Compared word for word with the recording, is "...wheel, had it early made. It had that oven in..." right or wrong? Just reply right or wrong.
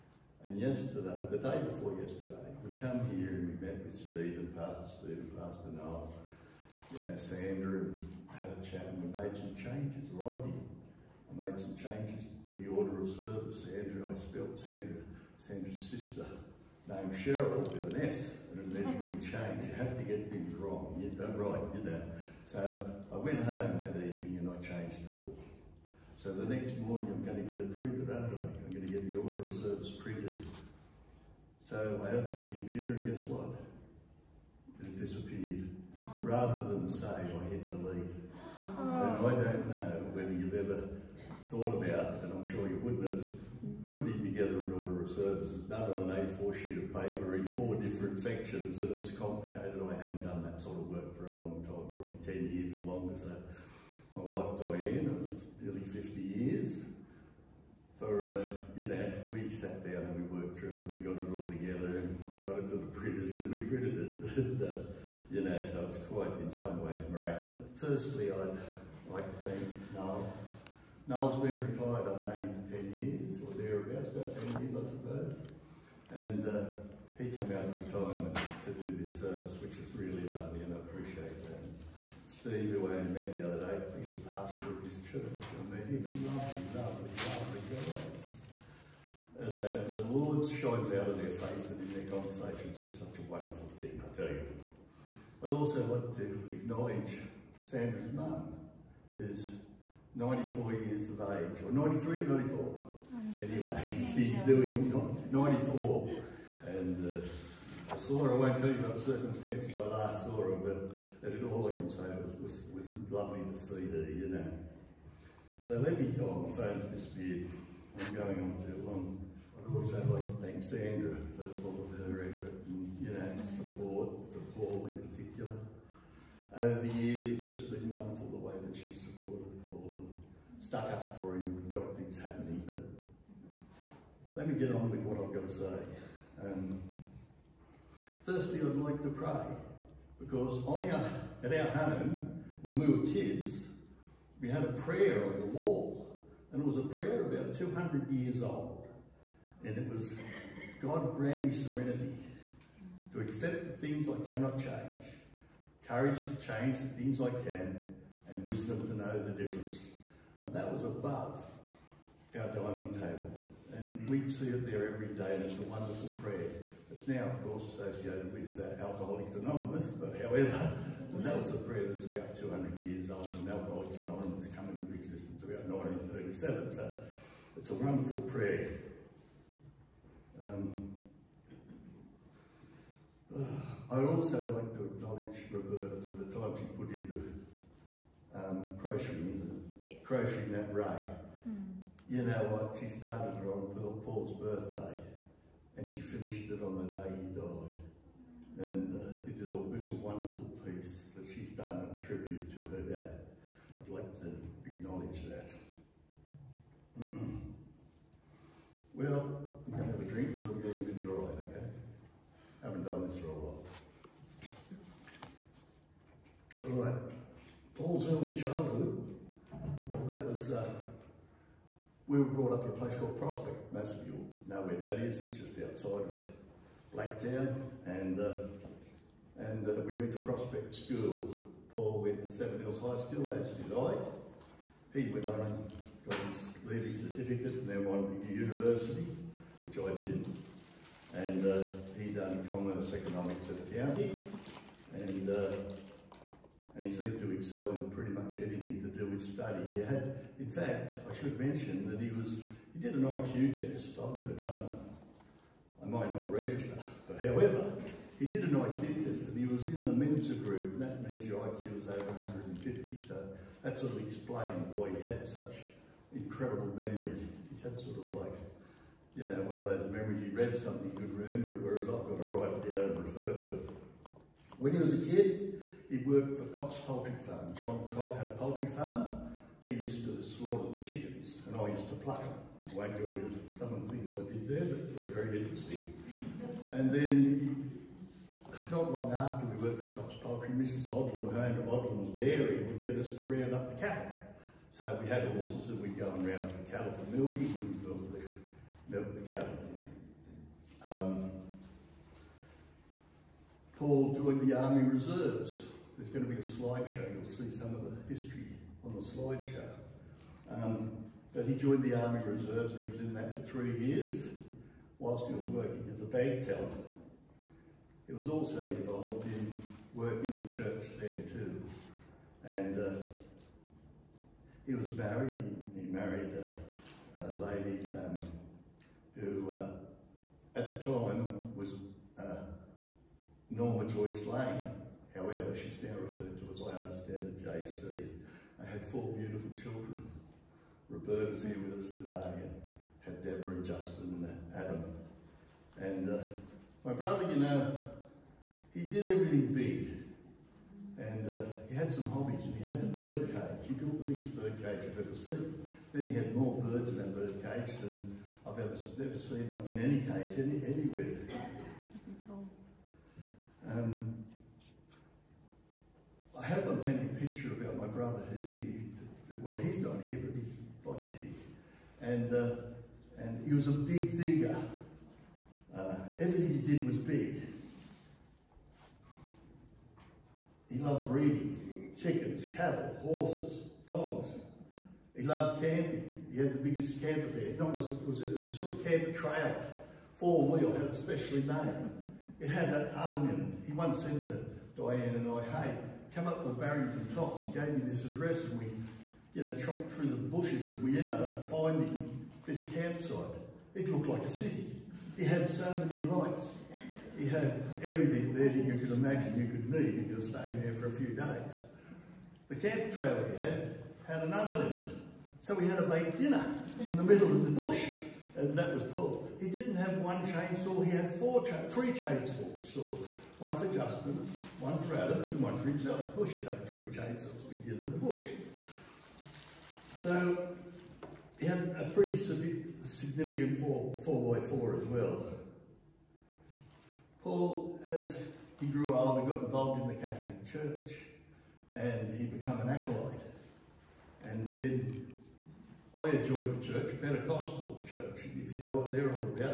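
wrong.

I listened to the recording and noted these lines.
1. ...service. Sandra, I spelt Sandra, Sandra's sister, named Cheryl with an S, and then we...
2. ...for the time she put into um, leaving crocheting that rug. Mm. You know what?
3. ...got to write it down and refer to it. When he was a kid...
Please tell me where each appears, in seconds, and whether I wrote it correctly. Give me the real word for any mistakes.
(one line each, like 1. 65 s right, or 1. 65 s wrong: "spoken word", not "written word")
1. 13 s right
2. 186 s wrong: "crocheting", not "leaving"
3. 272 s right.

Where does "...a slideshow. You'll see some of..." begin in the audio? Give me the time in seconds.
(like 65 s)
306 s.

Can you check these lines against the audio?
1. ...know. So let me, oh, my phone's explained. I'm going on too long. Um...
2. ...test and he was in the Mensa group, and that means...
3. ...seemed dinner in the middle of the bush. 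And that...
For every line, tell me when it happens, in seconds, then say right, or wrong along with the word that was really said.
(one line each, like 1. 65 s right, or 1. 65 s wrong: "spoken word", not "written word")
1. 114 s wrong: "disappeared", not "explained"
2. 259 s right
3. 415 s wrong: "baked", not "seemed".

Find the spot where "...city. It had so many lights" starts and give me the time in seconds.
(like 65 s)
404 s.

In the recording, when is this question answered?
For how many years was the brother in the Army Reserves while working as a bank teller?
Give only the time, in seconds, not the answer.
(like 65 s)
313 s.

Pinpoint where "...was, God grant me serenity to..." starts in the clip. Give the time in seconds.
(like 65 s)
149 s.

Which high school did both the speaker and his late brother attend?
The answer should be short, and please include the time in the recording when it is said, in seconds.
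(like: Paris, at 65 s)
Seven Hills High School, at 232 s.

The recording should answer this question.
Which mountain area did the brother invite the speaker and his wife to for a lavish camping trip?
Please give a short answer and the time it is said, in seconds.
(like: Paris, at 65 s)
Barrington Tops, at 396 s.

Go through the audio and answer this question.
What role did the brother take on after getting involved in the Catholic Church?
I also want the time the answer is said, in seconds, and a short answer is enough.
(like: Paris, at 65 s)
acolyte, at 442 s.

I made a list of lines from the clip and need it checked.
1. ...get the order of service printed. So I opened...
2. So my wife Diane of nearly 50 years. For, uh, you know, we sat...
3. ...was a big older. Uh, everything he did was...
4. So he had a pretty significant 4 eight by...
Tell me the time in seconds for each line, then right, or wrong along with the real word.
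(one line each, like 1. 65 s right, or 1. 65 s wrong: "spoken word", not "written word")
1. 28 s right
2. 53 s right
3. 373 s wrong: "thinker", not "older"
4. 429 s wrong: "four", not "eight".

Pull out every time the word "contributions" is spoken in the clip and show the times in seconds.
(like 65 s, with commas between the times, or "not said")
not said.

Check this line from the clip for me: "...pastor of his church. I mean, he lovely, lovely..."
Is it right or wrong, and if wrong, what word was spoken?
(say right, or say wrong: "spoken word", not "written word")
right.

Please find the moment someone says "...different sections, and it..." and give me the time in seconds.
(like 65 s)
47 s.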